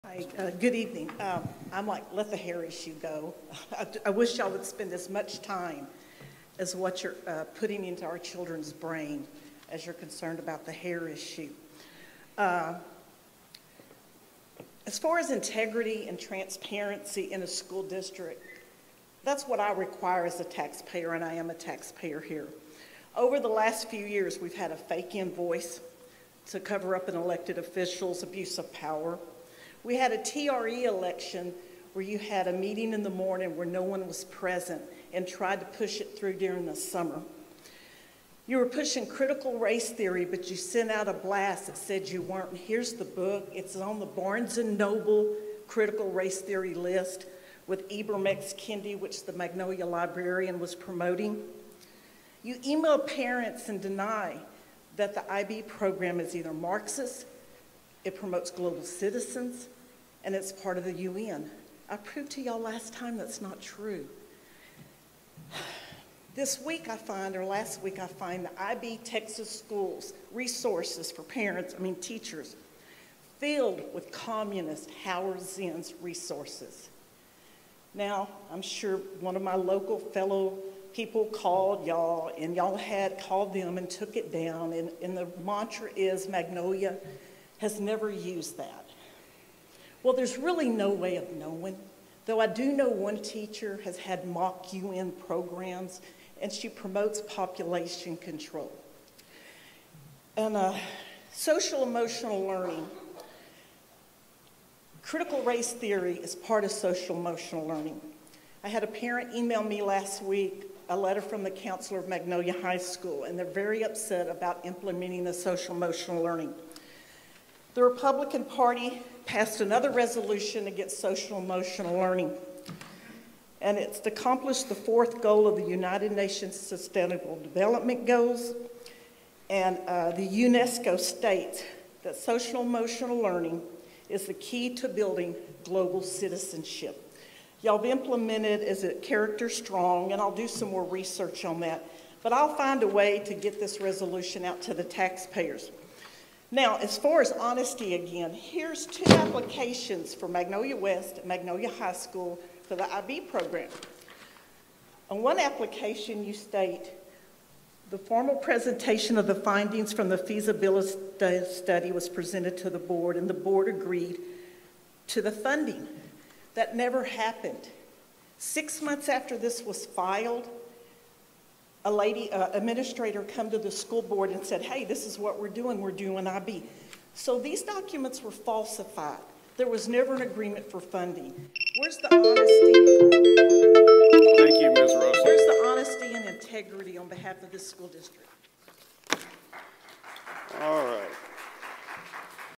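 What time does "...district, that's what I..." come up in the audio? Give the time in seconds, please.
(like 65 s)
17 s.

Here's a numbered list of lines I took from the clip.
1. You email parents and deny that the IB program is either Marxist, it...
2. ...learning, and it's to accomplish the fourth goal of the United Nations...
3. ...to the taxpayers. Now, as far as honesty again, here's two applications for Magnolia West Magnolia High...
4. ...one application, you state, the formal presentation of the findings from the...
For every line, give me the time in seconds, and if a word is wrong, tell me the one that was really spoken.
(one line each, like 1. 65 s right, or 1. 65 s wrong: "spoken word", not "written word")
1. 52 s right
2. 121 s right
3. 144 s right
4. 155 s right.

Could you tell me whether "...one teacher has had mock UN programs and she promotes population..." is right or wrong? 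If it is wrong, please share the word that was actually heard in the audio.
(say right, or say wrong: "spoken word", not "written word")
right.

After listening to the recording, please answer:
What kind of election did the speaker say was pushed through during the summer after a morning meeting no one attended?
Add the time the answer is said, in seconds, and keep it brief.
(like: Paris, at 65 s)
TRE election, at 30 s.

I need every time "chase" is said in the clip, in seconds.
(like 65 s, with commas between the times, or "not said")
not said.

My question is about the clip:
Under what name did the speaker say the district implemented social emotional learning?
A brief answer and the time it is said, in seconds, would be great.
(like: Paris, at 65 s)
Character Strong, at 138 s.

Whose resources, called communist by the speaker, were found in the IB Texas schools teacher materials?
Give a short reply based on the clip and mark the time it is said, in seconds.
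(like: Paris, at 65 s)
Howard Zinn, at 75 s.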